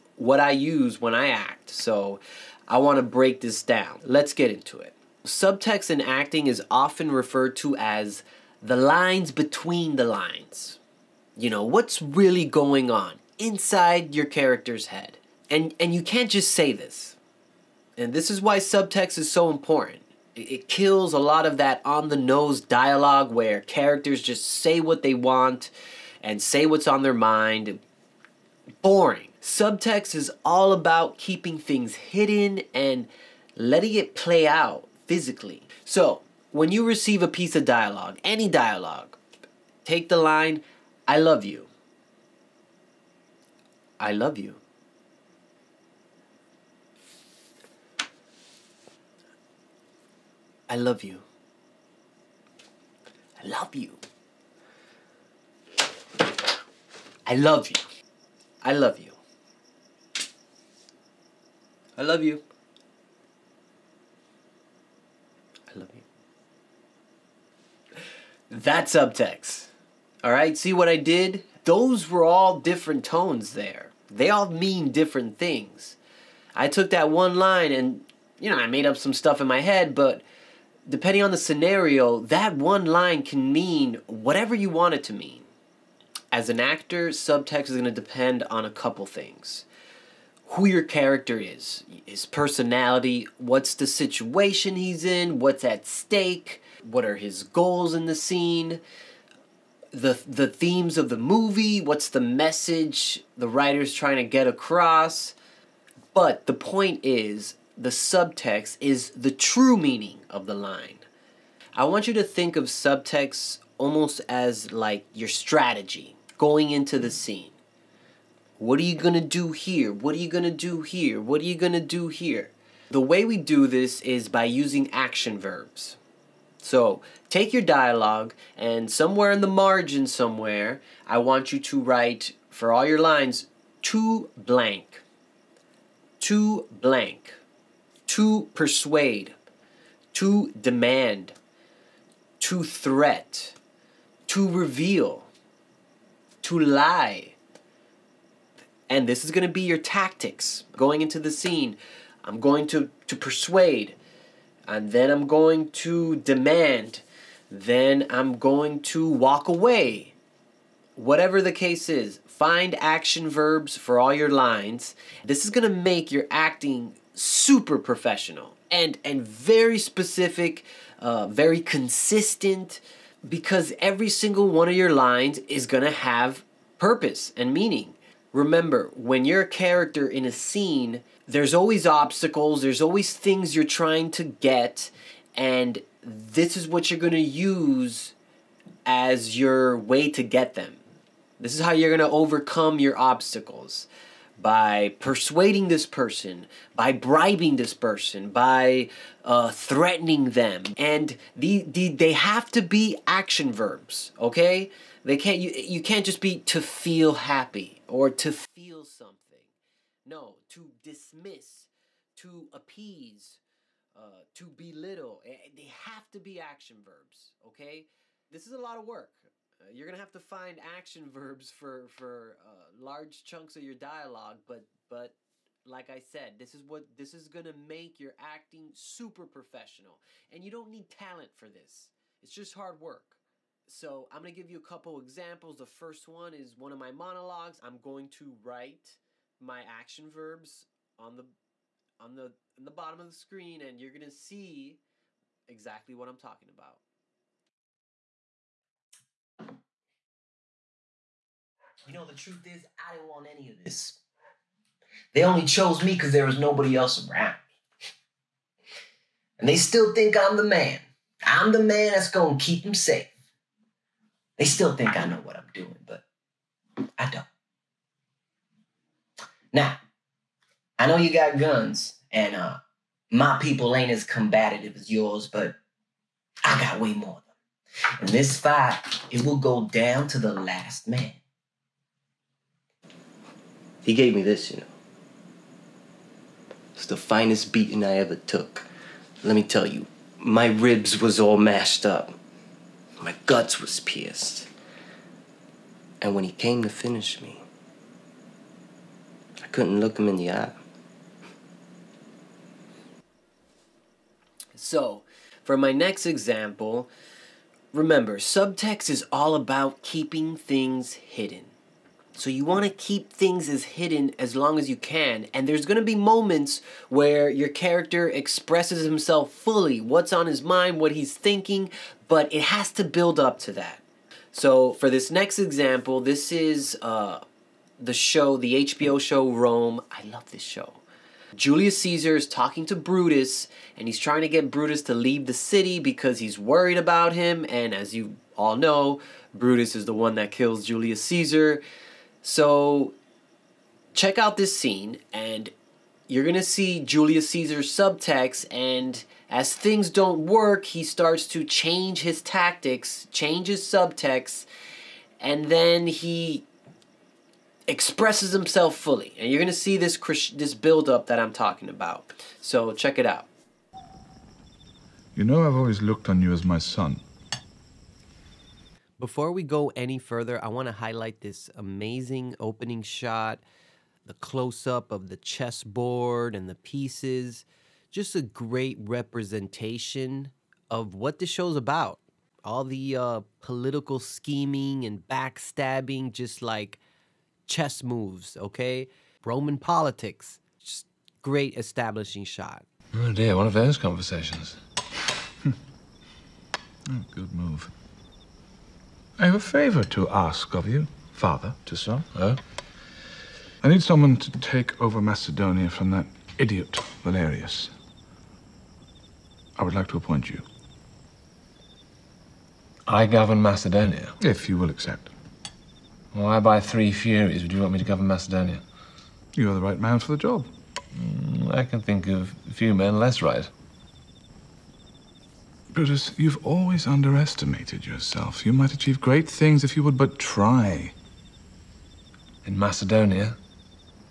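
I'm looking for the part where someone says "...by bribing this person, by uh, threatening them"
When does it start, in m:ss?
3:16.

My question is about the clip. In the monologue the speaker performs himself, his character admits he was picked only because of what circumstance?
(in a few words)
Nobody else around.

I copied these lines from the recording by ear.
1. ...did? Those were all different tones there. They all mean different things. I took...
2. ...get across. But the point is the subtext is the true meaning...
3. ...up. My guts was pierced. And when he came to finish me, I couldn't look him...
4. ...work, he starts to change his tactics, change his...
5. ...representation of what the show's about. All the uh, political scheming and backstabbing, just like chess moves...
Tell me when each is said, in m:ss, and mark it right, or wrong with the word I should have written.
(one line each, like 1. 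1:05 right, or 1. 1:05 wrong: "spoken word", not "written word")
1. 1:10 right
2. 1:44 right
3. 4:51 right
4. 5:50 right
5. 6:18 right.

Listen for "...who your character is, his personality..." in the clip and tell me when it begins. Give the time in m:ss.
1:30.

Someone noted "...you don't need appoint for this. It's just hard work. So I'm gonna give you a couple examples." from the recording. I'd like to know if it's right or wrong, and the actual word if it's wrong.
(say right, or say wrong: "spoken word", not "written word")
wrong: "talent", not "appoint".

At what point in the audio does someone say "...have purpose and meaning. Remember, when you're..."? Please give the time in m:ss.
2:55.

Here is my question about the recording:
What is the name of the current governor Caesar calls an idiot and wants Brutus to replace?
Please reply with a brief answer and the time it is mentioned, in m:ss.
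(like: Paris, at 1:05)
Valerius, at 6:47.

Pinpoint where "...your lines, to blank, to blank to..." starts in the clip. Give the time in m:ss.
2:12.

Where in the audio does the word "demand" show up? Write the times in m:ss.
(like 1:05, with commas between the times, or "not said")
2:20, 2:36.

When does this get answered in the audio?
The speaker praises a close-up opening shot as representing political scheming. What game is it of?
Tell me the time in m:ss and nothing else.
6:15.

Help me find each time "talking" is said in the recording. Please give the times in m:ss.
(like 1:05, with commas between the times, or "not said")
4:06, 5:32, 6:01.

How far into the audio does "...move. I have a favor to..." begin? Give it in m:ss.
6:37.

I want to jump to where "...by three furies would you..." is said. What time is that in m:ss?
6:56.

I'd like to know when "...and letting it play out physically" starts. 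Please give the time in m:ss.
0:32.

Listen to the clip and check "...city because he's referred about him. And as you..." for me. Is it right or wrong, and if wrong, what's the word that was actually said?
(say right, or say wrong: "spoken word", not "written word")
wrong: "worried", not "referred".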